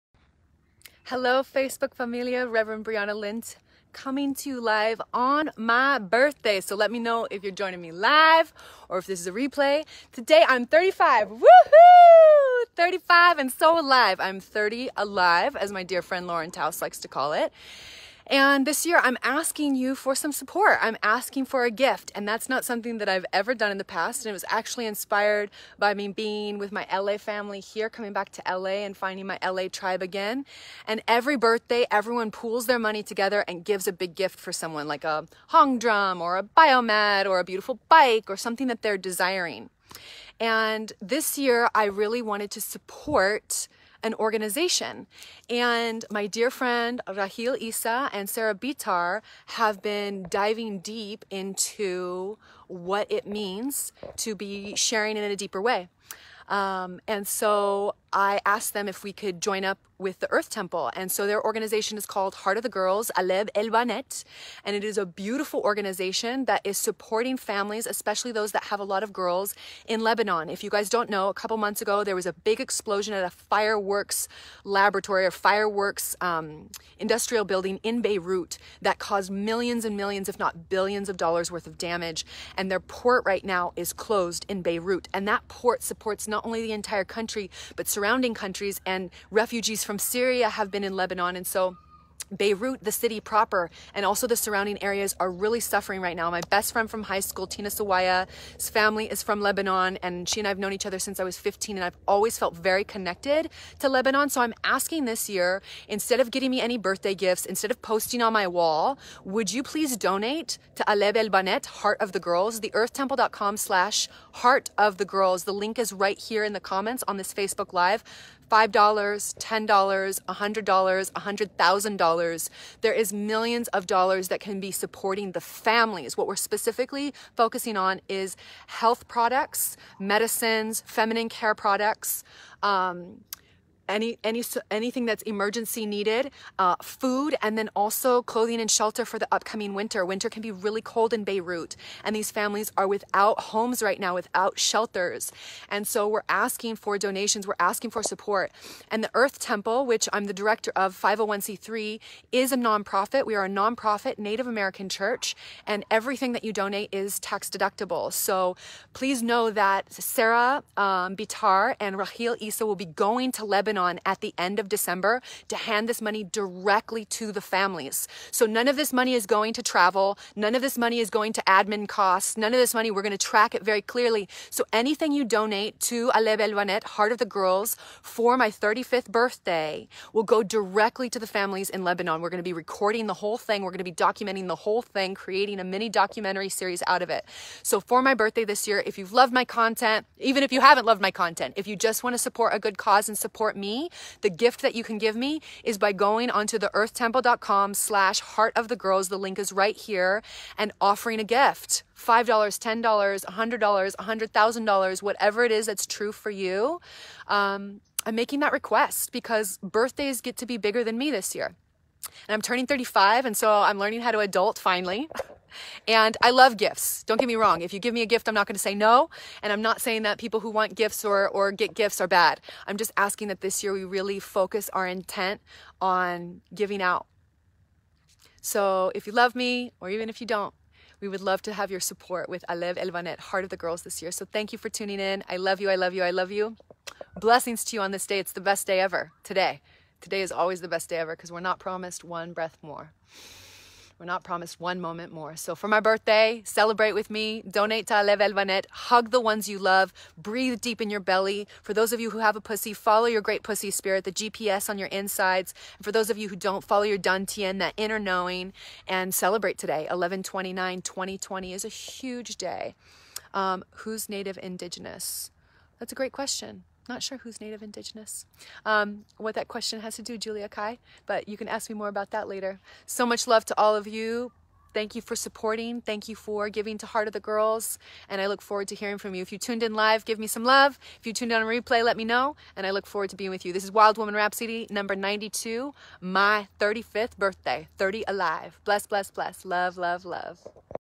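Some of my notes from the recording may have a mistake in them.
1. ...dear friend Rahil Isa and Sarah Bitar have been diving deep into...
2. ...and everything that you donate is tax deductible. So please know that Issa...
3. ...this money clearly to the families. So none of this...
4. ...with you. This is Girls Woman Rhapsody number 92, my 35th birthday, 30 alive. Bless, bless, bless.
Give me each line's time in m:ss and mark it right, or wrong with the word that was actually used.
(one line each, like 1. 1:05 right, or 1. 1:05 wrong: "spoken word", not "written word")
1. 0:46 right
2. 2:35 wrong: "Sarah", not "Issa"
3. 2:45 wrong: "directly", not "clearly"
4. 4:43 wrong: "Wild", not "Girls".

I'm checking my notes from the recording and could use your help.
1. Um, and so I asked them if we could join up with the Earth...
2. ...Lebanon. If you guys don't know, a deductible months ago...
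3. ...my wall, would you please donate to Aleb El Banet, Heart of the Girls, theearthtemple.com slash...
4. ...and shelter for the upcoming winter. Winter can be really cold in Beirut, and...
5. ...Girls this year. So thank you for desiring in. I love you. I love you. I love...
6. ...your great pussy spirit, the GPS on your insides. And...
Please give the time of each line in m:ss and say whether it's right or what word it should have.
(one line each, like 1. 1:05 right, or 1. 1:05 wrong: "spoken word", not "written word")
1. 0:56 right
2. 1:10 wrong: "couple", not "deductible"
3. 1:48 right
4. 2:18 right
5. 3:53 wrong: "tuning", not "desiring"
6. 4:13 right.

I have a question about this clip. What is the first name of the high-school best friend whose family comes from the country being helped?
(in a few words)
Tina.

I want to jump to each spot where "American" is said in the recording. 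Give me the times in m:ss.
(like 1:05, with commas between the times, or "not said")
2:34.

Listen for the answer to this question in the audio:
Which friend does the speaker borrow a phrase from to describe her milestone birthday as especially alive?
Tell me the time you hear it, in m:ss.
0:16.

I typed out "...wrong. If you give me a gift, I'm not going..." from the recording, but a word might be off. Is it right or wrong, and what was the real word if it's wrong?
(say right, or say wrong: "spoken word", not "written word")
right.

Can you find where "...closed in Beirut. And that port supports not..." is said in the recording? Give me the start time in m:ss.
1:23.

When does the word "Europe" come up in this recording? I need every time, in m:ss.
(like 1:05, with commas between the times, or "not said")
not said.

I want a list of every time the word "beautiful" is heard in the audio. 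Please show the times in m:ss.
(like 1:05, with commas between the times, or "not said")
0:37, 1:05.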